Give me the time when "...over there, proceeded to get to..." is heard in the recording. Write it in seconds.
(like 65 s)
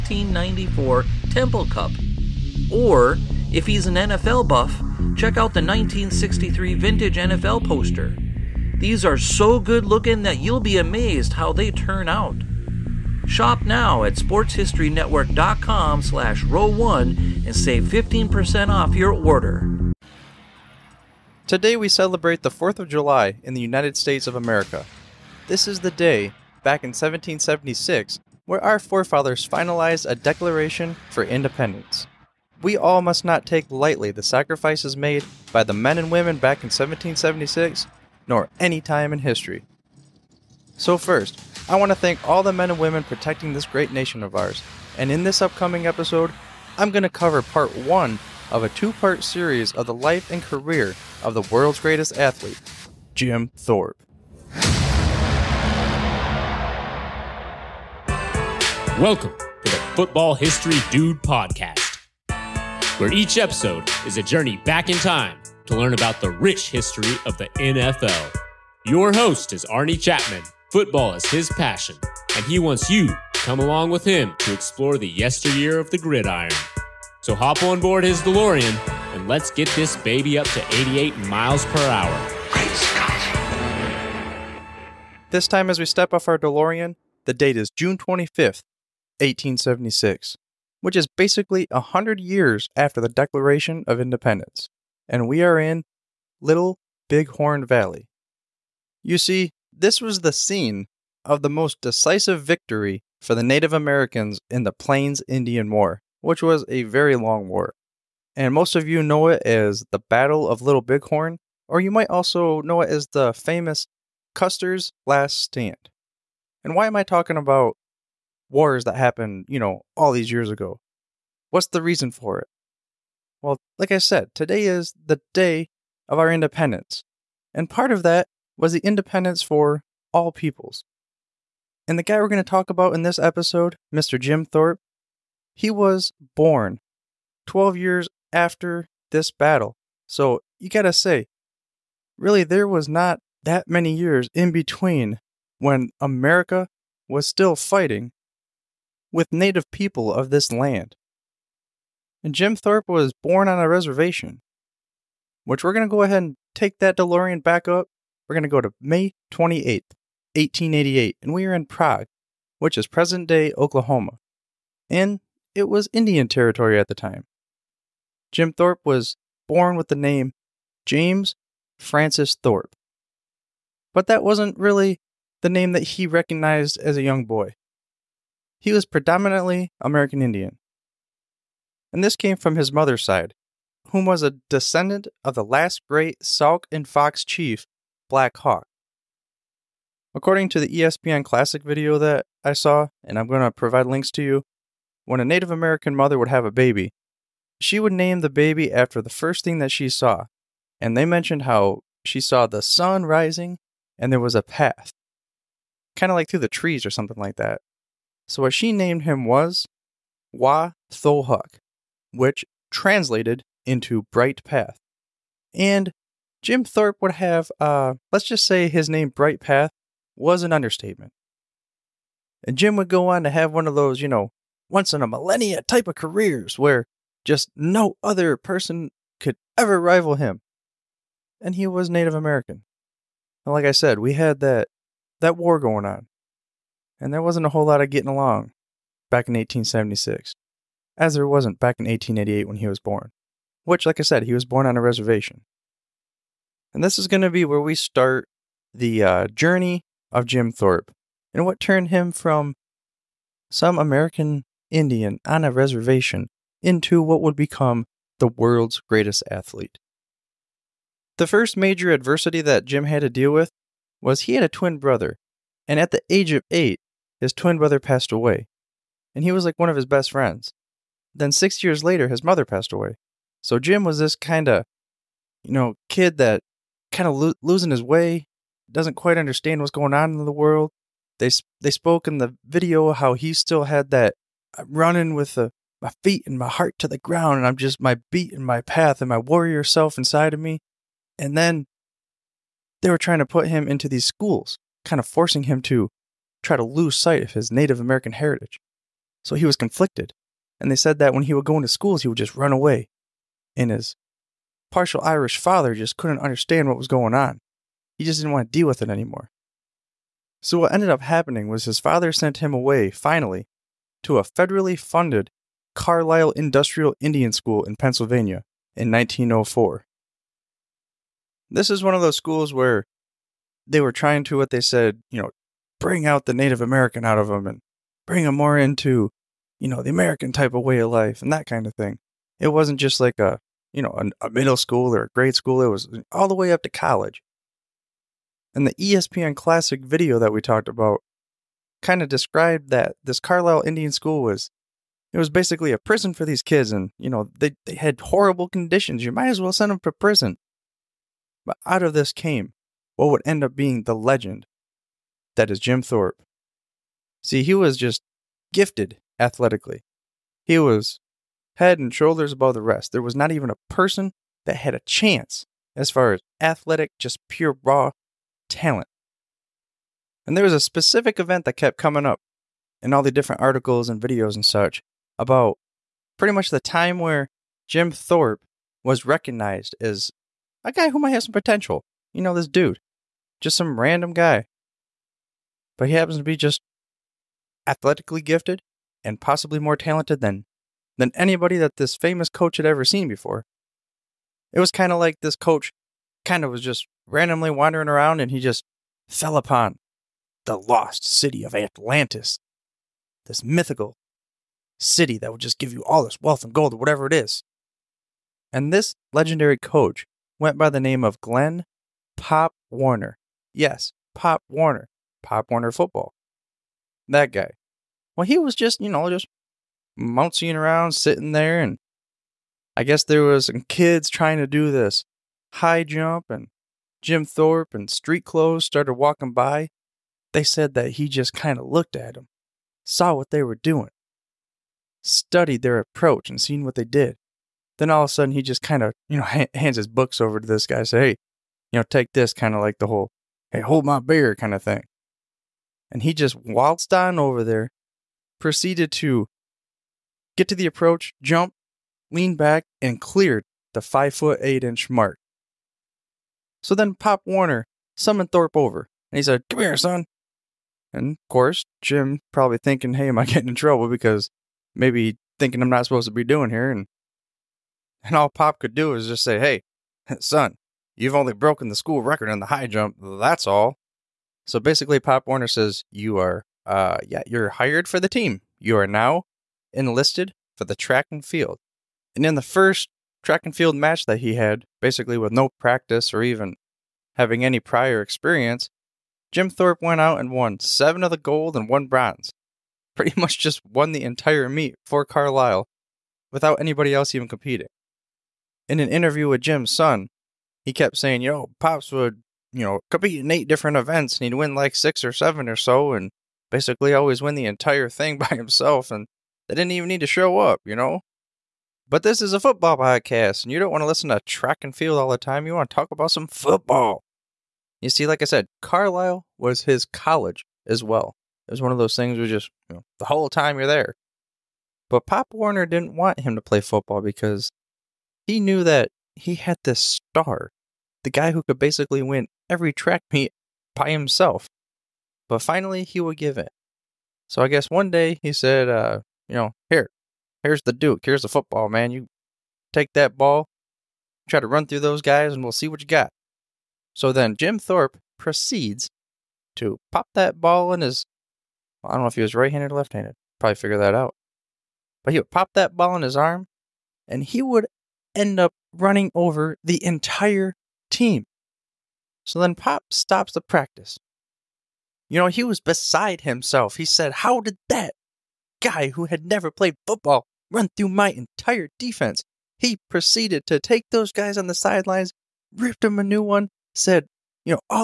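447 s.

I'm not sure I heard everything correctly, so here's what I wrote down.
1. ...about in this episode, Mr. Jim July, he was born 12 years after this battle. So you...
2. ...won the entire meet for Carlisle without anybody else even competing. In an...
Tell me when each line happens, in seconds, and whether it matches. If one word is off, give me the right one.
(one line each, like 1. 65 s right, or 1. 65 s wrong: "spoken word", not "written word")
1. 132 s wrong: "Thorpe", not "July"
2. 493 s right.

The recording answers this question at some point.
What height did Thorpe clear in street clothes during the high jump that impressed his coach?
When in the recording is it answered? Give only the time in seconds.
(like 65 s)
453 s.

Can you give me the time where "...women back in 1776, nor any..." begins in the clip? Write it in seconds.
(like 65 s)
36 s.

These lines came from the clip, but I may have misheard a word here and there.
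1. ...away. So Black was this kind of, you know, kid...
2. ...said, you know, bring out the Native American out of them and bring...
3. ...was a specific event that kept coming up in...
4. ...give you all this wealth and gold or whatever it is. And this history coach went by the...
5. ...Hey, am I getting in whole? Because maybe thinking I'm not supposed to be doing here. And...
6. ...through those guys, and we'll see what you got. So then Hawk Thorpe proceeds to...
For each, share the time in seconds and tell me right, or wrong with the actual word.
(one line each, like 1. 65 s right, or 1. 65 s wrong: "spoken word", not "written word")
1. 272 s wrong: "Jim", not "Black"
2. 324 s right
3. 370 s right
4. 405 s wrong: "legendary", not "history"
5. 462 s wrong: "trouble", not "whole"
6. 544 s wrong: "Jim", not "Hawk".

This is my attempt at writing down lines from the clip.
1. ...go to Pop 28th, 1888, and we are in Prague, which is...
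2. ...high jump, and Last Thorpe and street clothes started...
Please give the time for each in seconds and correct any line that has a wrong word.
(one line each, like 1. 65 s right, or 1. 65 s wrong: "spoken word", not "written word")
1. 158 s wrong: "May", not "Pop"
2. 425 s wrong: "Jim", not "Last".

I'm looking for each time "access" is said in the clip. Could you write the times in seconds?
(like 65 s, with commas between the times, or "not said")
not said.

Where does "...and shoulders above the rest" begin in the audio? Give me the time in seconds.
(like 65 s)
361 s.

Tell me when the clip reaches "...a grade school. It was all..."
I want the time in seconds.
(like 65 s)
335 s.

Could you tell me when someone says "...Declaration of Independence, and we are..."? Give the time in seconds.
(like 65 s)
93 s.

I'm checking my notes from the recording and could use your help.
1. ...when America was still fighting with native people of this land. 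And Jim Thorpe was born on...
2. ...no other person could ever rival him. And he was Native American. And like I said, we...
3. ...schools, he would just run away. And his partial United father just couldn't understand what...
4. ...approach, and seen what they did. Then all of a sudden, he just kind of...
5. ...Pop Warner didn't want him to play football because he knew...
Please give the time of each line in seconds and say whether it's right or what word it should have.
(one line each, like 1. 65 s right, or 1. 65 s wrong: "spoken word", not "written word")
1. 145 s right
2. 227 s right
3. 301 s wrong: "Irish", not "United"
4. 435 s right
5. 525 s right.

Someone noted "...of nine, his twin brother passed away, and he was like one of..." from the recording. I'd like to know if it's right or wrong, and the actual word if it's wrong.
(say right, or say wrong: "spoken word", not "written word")
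wrong: "eight", not "nine".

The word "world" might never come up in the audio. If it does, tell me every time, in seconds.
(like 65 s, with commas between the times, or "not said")
51 s, 258 s, 280 s.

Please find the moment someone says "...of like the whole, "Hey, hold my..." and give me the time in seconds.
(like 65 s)
442 s.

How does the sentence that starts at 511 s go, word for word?
But this is a football podcast and you don't want to listen to track and field all the time.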